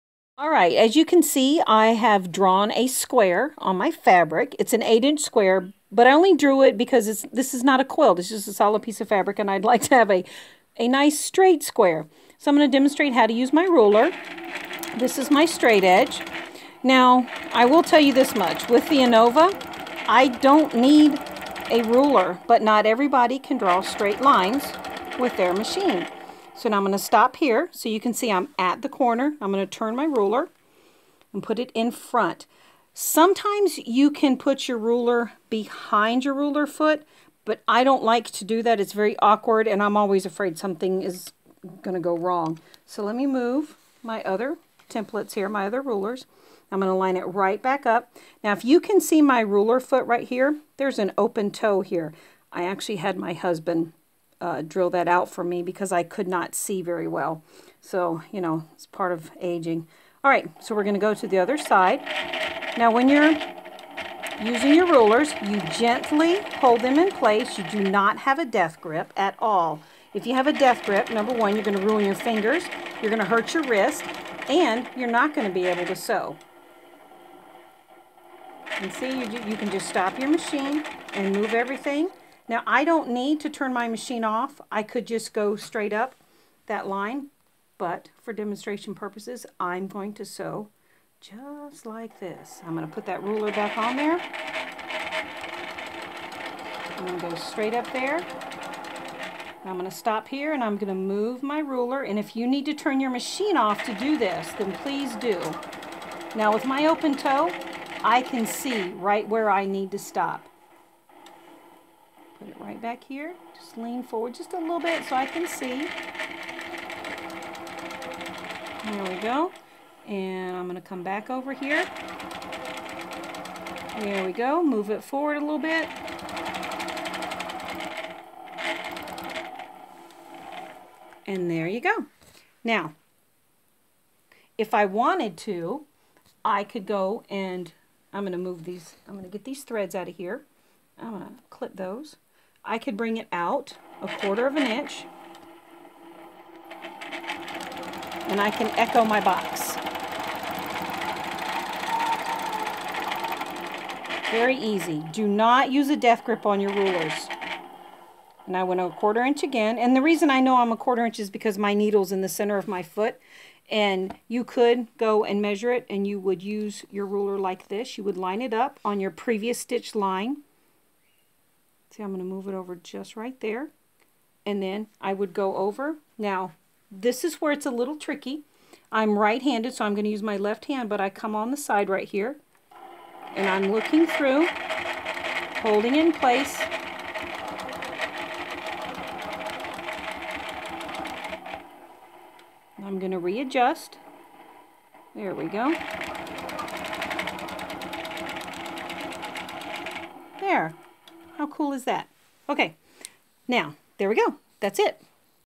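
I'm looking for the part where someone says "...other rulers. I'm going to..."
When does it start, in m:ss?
0:45.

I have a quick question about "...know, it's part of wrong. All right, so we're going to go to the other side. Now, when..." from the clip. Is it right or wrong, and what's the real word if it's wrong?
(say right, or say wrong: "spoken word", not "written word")
wrong: "aging", not "wrong".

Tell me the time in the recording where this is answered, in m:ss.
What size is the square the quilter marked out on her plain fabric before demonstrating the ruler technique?
0:04.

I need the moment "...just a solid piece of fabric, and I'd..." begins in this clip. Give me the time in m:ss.
0:08.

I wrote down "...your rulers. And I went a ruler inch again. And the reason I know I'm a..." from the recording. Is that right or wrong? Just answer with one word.
wrong.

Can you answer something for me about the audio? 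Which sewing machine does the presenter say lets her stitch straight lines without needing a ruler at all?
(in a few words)
Innova.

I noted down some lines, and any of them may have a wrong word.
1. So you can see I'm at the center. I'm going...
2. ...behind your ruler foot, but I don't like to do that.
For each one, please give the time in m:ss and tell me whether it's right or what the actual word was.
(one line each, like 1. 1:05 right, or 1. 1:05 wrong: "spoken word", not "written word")
1. 0:27 wrong: "corner", not "center"
2. 0:35 right.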